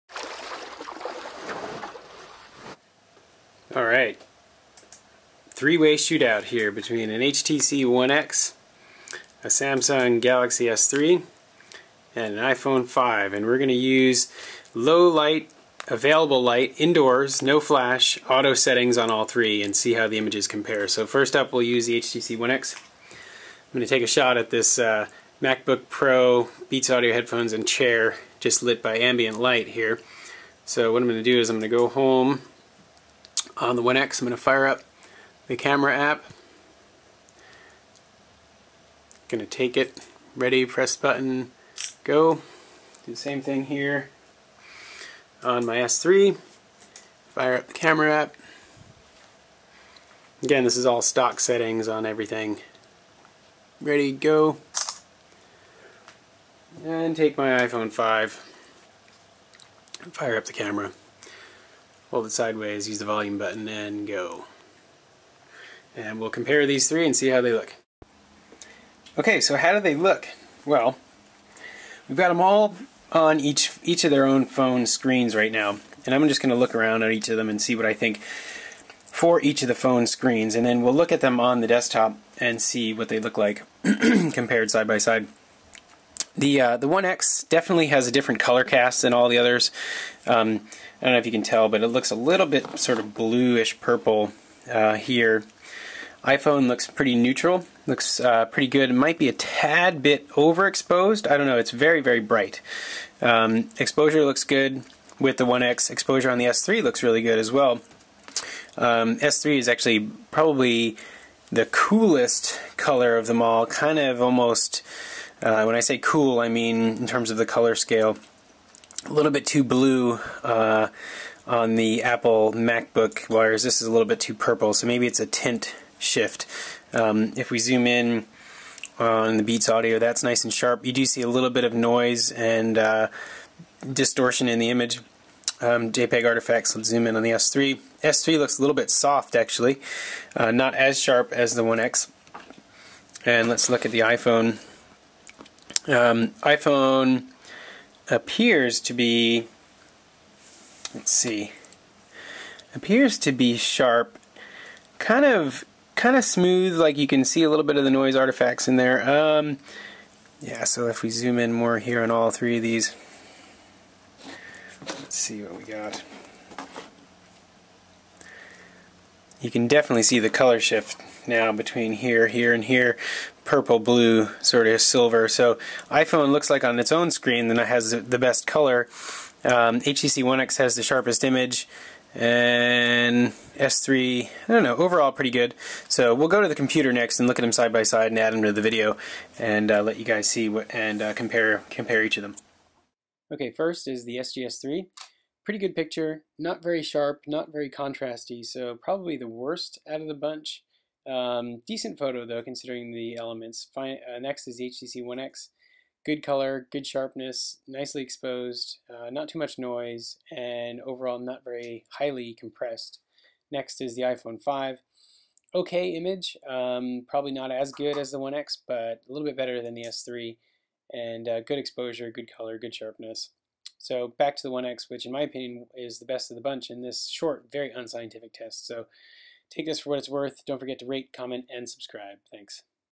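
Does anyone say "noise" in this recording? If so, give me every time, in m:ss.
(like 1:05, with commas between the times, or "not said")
2:11, 2:37, 3:29.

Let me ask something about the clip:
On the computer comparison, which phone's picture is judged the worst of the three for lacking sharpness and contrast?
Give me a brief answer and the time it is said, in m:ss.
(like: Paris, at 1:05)
SGS3, at 3:14.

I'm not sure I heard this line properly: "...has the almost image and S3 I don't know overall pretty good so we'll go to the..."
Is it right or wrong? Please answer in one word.
wrong.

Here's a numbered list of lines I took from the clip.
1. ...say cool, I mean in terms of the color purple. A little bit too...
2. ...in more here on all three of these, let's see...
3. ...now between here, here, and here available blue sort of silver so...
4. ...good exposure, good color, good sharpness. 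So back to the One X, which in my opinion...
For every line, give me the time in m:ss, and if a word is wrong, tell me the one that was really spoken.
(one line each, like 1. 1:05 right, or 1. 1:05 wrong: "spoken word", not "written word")
1. 1:55 wrong: "scale", not "purple"
2. 2:41 right
3. 2:51 wrong: "purple", not "available"
4. 3:41 right.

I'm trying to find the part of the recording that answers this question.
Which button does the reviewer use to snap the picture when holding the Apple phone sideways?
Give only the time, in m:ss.
1:03.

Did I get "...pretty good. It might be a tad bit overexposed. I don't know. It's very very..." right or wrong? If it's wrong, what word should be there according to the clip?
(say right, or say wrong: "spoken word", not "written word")
right.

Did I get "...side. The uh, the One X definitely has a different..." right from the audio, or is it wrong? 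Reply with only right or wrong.
right.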